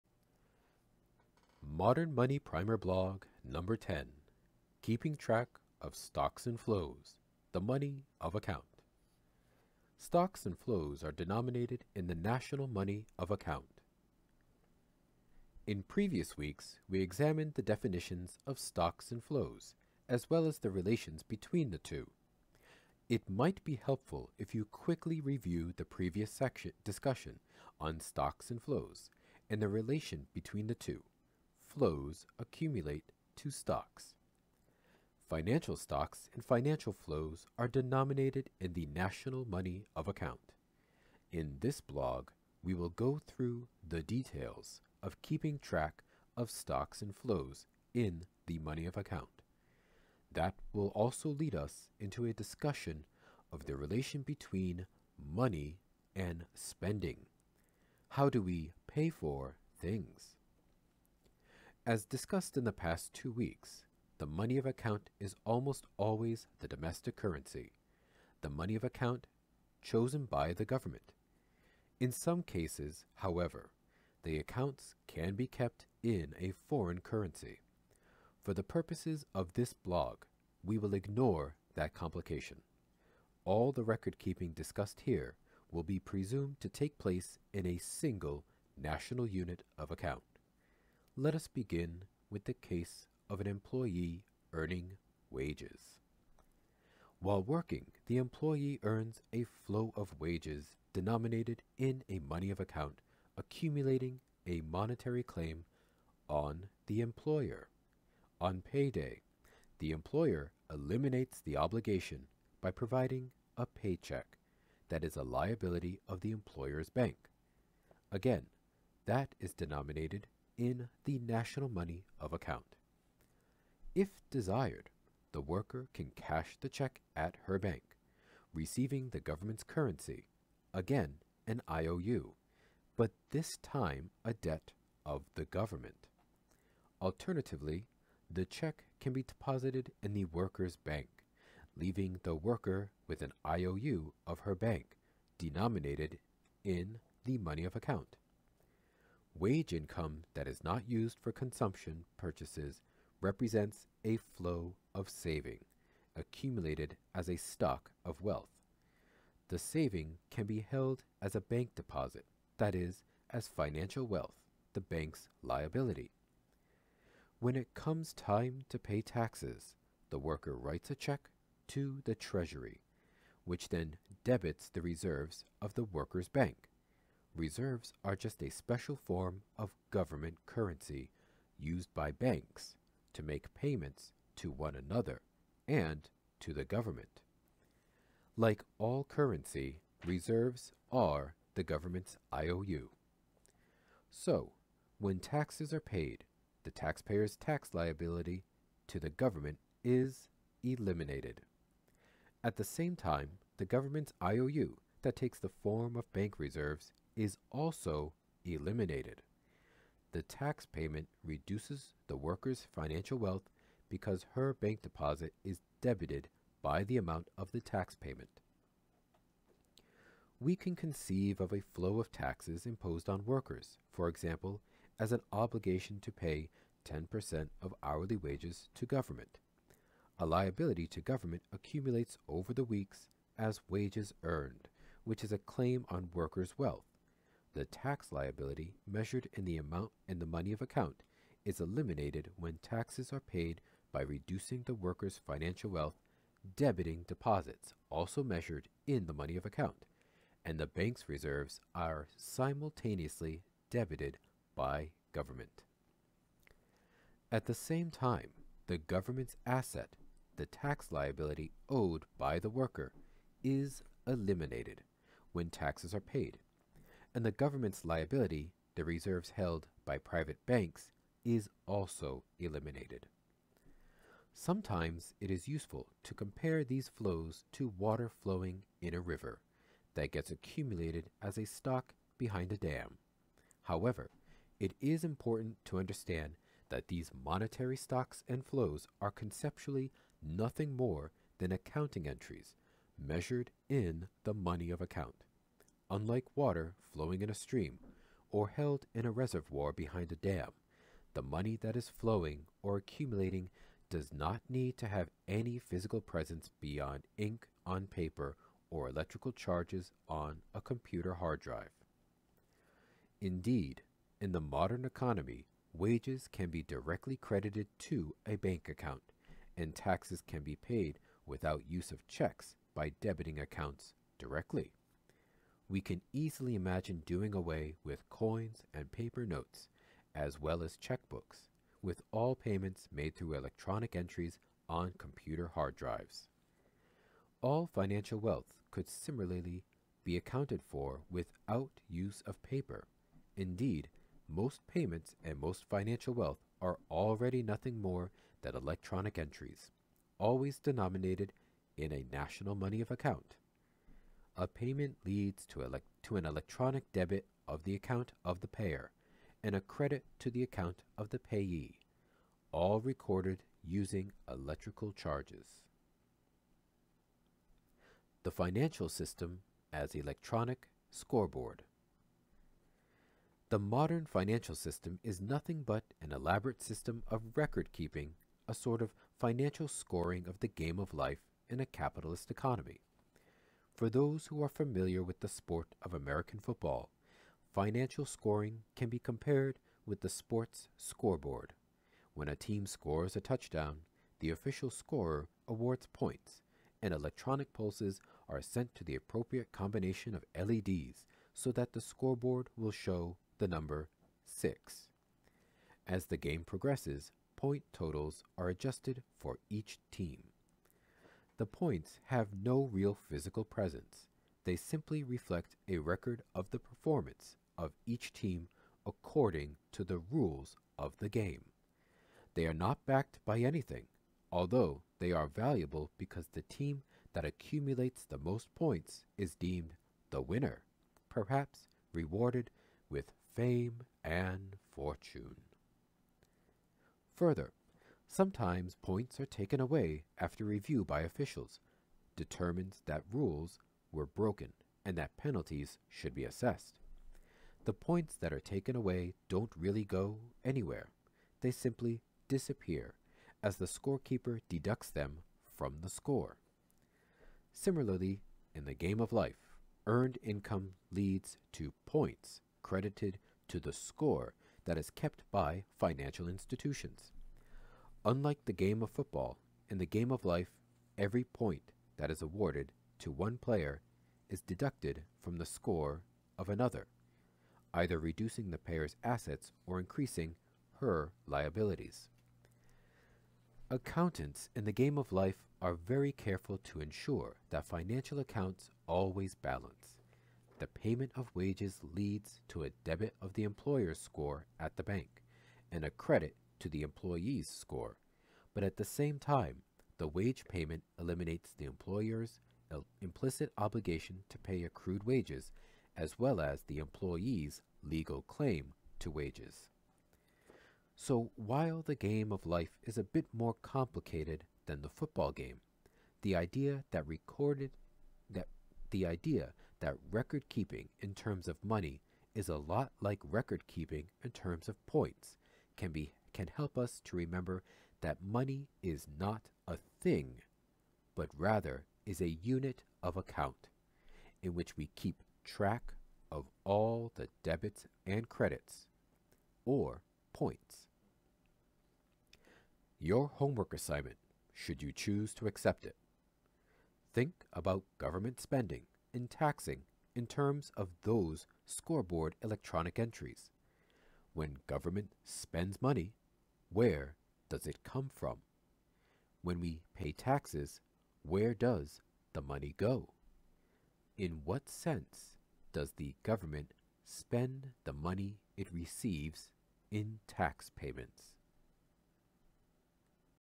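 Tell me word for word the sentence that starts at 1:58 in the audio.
Again, that is denominated in the national money of account.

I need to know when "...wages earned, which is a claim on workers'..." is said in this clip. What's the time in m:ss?
3:53.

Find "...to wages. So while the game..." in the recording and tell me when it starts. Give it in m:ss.
8:28.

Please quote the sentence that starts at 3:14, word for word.
So, when taxes are paid, the taxpayer's tax liability to the government is eliminated.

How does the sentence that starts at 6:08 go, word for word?
The financial system as electronic scoreboard.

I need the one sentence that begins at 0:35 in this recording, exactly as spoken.
Financial stocks and financial flows are denominated in the national money of account.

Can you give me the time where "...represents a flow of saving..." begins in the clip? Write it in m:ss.
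2:33.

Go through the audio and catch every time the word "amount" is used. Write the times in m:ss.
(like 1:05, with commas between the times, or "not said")
3:36, 3:59.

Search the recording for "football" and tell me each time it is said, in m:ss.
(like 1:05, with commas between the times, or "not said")
6:26, 7:48, 8:34.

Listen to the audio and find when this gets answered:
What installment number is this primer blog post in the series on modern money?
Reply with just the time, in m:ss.
0:03.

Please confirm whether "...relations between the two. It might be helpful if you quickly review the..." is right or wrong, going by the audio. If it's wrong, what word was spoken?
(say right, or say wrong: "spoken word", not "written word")
right.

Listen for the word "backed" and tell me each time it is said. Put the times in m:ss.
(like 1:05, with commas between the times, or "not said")
7:02.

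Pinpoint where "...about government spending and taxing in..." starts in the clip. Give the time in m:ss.
9:07.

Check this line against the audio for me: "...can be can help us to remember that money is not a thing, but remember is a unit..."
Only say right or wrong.
wrong.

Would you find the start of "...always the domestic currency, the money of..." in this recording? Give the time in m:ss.
1:05.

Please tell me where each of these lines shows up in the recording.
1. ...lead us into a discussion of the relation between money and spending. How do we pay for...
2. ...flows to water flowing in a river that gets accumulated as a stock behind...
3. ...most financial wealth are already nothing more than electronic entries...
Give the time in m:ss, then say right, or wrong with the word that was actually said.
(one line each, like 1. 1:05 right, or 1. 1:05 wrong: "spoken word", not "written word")
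1. 0:51 right
2. 4:36 right
3. 5:45 right.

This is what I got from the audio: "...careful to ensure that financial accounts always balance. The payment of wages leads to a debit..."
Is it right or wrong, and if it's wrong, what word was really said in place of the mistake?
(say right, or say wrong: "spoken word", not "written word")
right.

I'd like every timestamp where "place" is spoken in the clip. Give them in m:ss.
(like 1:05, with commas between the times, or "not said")
1:26.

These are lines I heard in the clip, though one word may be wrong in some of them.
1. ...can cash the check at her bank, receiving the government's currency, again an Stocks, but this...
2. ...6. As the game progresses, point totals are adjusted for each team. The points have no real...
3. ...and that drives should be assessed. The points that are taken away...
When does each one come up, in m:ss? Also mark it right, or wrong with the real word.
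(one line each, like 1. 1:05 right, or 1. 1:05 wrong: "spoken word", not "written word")
1. 2:05 wrong: "IOU", not "Stocks"
2. 6:44 right
3. 7:24 wrong: "penalties", not "drives".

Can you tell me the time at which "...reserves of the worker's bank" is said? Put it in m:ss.
2:54.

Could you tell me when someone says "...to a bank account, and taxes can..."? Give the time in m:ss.
5:17.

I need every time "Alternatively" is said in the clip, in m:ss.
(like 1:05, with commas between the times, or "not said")
2:17.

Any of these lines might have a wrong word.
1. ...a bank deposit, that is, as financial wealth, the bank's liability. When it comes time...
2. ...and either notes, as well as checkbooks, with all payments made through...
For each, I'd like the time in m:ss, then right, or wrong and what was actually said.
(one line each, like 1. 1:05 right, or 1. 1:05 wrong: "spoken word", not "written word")
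1. 2:41 right
2. 5:28 wrong: "paper", not "either".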